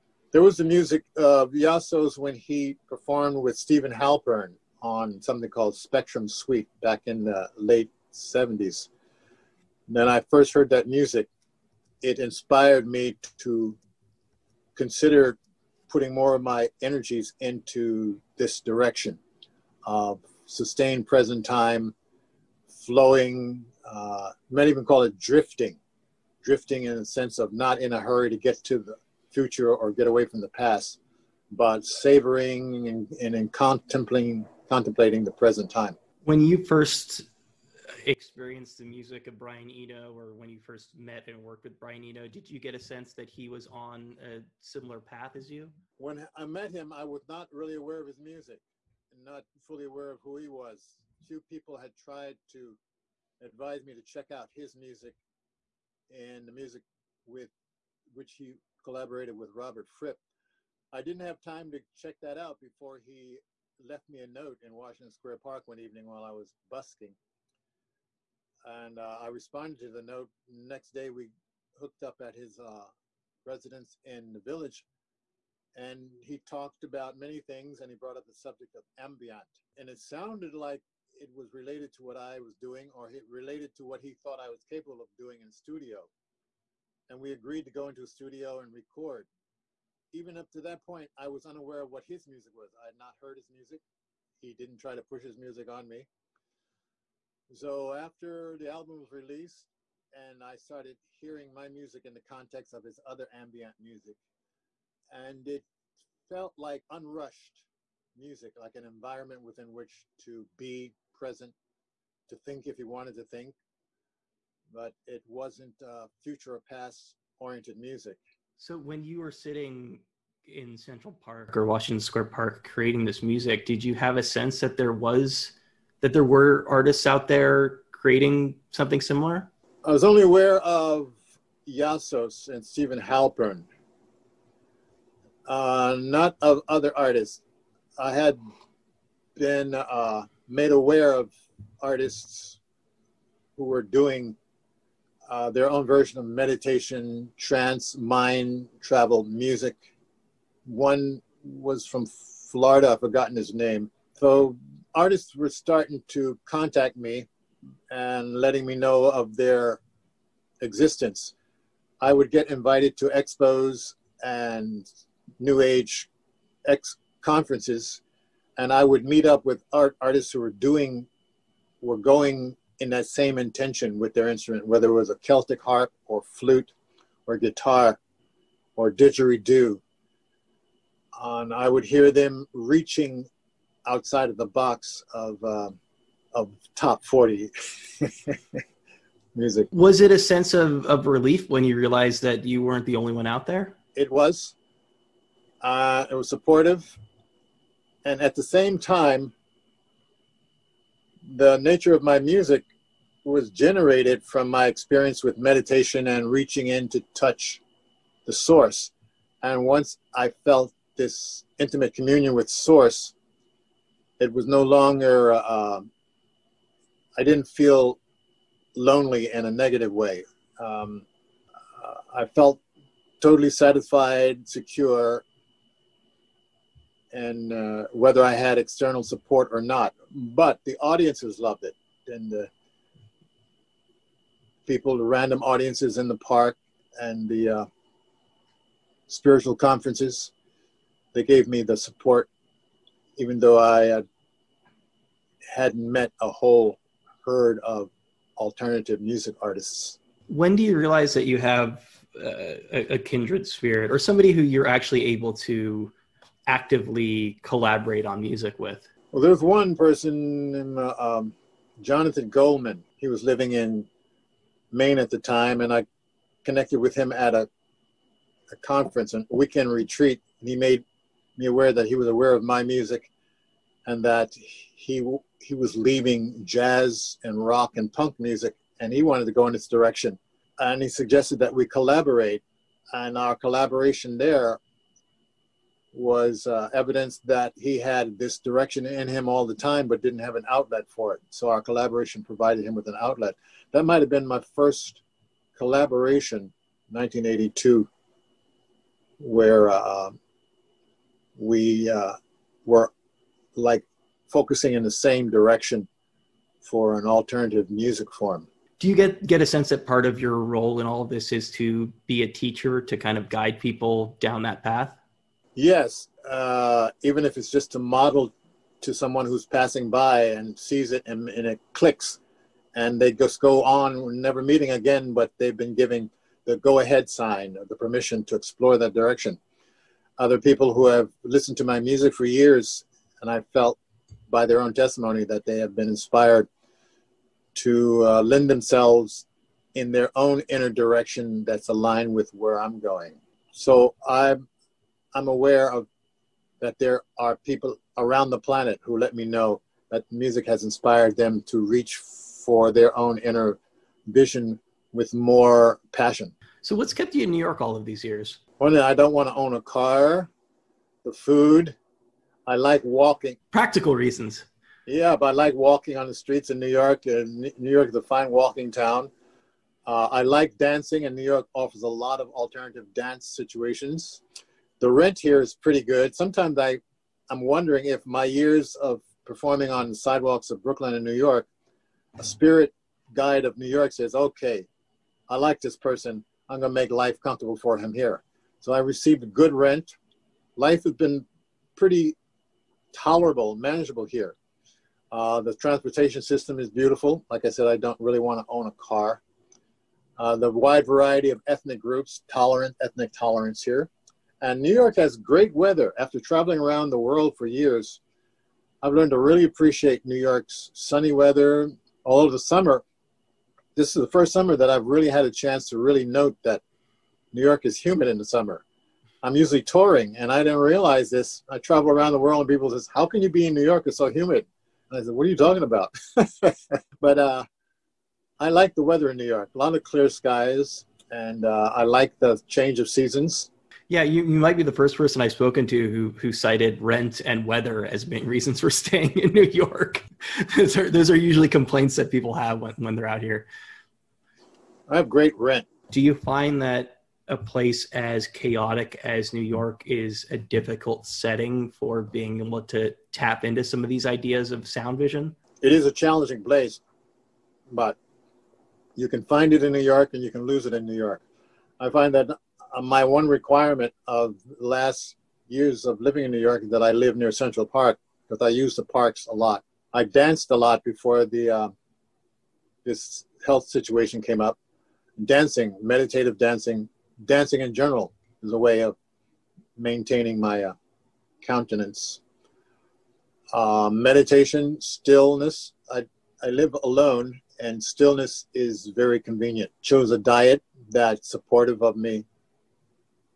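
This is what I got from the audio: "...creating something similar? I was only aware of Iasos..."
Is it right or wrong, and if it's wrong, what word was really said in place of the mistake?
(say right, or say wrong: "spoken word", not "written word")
right.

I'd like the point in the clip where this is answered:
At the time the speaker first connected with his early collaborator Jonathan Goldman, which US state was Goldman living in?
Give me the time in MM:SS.
04:24.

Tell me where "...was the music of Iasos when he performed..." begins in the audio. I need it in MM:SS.
00:00.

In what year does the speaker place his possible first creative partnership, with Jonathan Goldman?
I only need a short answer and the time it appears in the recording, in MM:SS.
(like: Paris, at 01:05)
1982, at 04:56.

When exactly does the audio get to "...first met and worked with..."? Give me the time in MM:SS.
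00:40.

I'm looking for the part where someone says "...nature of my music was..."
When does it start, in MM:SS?
03:21.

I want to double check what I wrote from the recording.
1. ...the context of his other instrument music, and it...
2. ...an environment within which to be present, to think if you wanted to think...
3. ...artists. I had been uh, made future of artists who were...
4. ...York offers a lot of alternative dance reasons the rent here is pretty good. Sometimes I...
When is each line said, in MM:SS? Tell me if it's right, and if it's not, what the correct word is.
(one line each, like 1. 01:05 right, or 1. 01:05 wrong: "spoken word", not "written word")
1. 01:42 wrong: "ambient", not "instrument"
2. 01:48 right
3. 02:16 wrong: "aware", not "future"
4. 06:11 wrong: "situations", not "reasons".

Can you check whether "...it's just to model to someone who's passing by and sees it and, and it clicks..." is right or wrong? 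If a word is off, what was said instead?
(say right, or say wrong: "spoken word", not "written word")
right.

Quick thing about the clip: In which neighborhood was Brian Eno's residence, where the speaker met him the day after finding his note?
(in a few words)
the Village.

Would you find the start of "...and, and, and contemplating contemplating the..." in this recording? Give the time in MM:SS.
00:32.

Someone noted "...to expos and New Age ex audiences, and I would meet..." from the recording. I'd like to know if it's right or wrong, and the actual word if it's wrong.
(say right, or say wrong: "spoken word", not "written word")
wrong: "conferences", not "audiences".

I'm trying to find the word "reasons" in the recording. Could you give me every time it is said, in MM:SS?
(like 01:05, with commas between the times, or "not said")
06:03, 07:18.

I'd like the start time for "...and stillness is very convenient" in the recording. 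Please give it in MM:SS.
08:07.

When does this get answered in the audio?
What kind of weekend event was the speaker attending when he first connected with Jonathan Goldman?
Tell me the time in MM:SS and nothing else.
04:29.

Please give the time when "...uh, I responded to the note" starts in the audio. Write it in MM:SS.
01:08.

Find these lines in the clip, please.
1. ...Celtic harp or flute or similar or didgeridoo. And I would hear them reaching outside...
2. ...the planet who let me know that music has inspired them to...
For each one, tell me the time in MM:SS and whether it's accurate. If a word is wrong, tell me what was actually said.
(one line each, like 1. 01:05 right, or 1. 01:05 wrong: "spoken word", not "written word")
1. 02:55 wrong: "guitar", not "similar"
2. 05:48 right.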